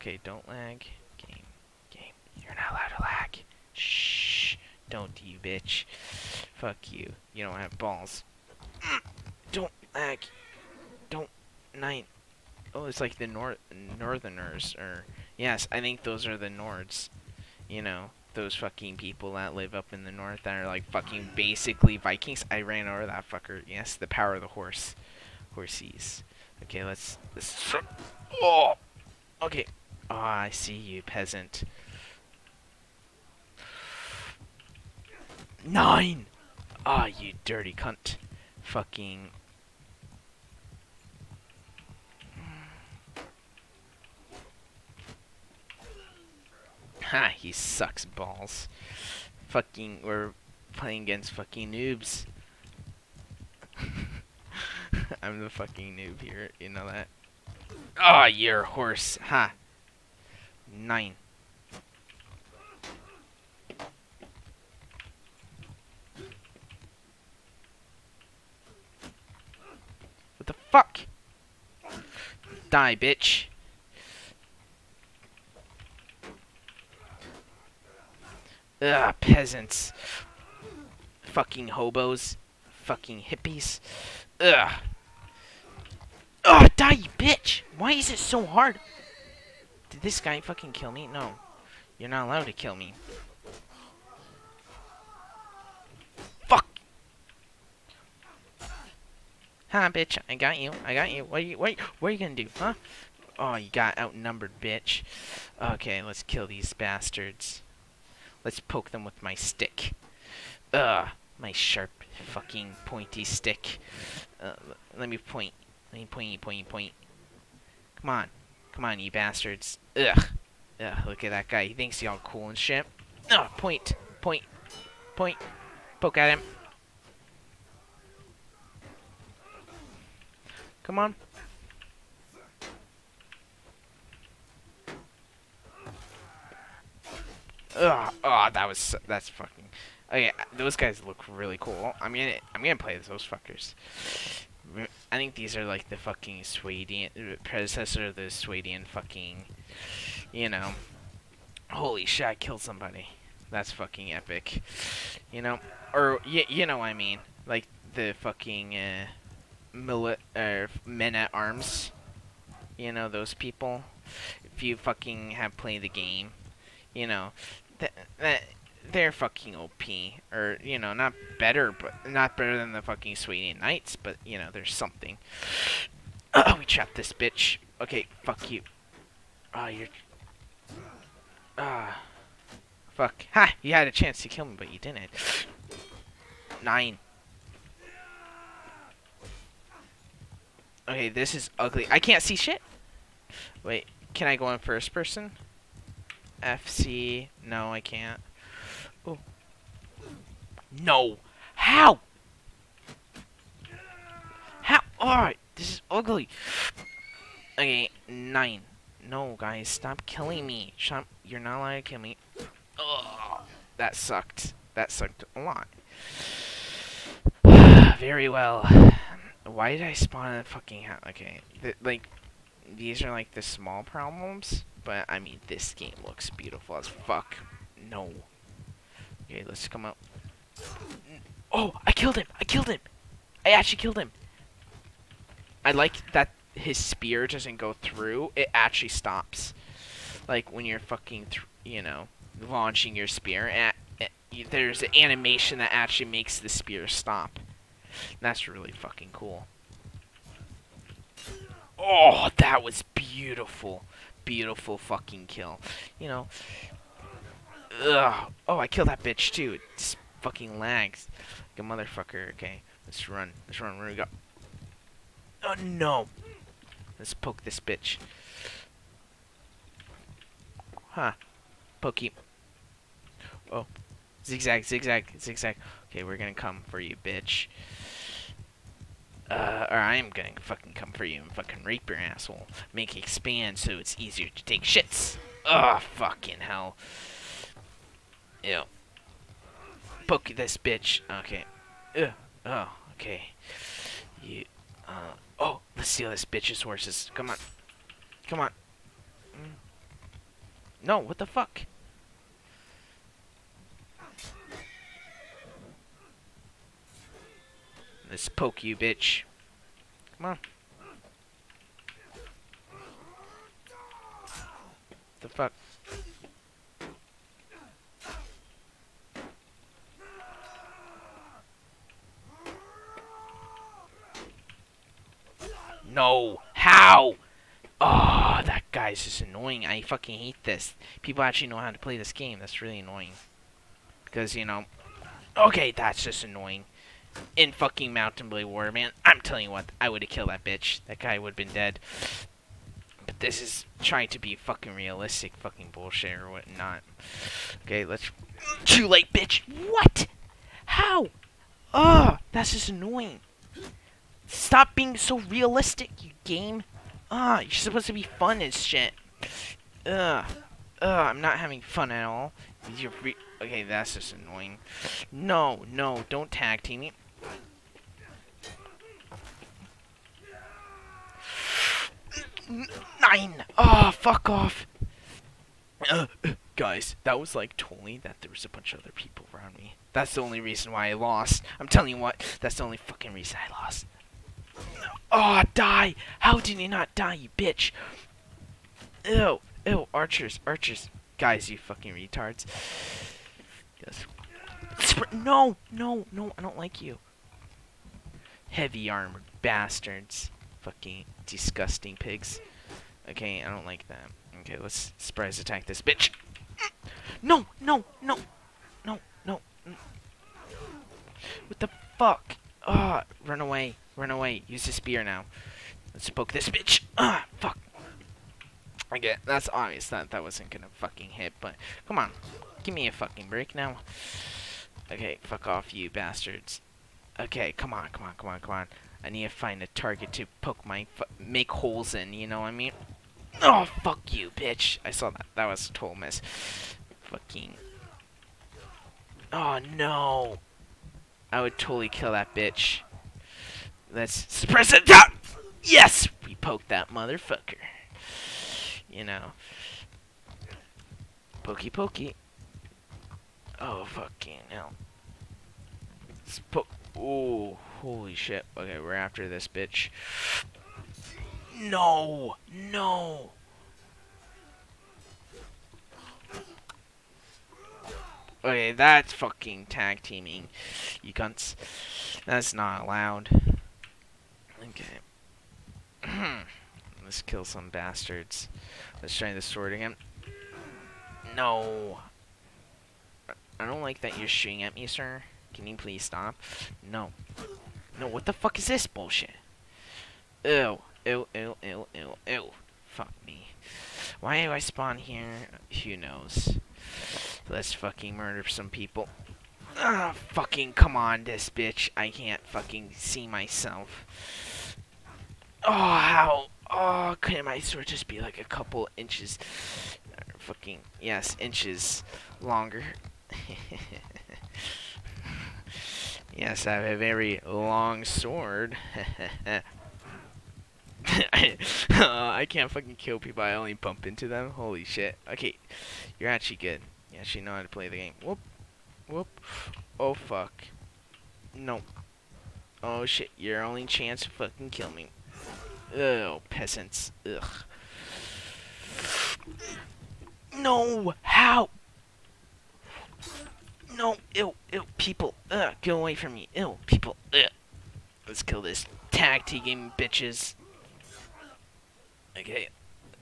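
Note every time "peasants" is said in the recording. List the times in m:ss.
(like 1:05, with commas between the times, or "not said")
0:31, 1:19, 8:56.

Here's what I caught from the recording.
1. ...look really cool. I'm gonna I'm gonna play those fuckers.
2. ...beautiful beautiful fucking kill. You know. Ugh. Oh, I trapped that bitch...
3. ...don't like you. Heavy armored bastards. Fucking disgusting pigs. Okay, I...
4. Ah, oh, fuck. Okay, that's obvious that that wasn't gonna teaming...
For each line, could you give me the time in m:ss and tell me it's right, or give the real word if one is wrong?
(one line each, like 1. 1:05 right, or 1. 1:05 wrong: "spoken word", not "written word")
1. 2:21 right
2. 4:12 wrong: "killed", not "trapped"
3. 6:36 right
4. 6:56 wrong: "fucking", not "teaming".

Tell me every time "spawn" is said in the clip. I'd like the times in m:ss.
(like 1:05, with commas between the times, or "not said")
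3:39, 8:14.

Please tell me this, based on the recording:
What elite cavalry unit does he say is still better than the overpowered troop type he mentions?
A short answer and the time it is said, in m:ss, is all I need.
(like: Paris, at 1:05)
Swadian Knights, at 2:53.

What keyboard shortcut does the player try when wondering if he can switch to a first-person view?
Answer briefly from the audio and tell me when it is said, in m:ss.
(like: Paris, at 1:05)
FC, at 3:16.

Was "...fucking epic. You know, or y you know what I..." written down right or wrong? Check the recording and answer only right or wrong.
right.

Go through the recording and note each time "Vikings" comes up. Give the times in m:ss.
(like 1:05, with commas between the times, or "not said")
0:21.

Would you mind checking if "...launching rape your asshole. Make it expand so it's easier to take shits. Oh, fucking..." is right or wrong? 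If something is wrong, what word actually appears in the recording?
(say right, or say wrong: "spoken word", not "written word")
wrong: "fucking", not "launching".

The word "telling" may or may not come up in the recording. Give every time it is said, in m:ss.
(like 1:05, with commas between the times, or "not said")
5:39, 6:21.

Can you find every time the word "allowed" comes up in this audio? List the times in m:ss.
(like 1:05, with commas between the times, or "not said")
0:02, 1:32, 3:31, 7:52.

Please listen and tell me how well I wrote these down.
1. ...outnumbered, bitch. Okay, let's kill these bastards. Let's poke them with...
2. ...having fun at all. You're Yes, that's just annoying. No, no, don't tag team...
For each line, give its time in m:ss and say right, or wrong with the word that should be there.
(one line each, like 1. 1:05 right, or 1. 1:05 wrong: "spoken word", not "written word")
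1. 1:43 right
2. 6:01 wrong: "Okay", not "Yes".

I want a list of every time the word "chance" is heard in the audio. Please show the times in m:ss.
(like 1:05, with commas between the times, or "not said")
3:03, 8:53.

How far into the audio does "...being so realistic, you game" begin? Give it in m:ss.
5:54.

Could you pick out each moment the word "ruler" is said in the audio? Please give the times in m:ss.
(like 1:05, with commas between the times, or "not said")
not said.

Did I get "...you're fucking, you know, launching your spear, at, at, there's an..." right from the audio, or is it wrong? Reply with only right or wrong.
right.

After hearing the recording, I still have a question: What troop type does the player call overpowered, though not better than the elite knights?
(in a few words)
men at arms.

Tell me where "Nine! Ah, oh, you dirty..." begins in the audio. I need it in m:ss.
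0:35.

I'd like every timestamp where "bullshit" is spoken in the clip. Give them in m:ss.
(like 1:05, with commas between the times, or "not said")
5:45, 8:08.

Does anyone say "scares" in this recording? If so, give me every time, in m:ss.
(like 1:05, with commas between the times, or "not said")
not said.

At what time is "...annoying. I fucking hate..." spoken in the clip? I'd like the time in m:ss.
5:29.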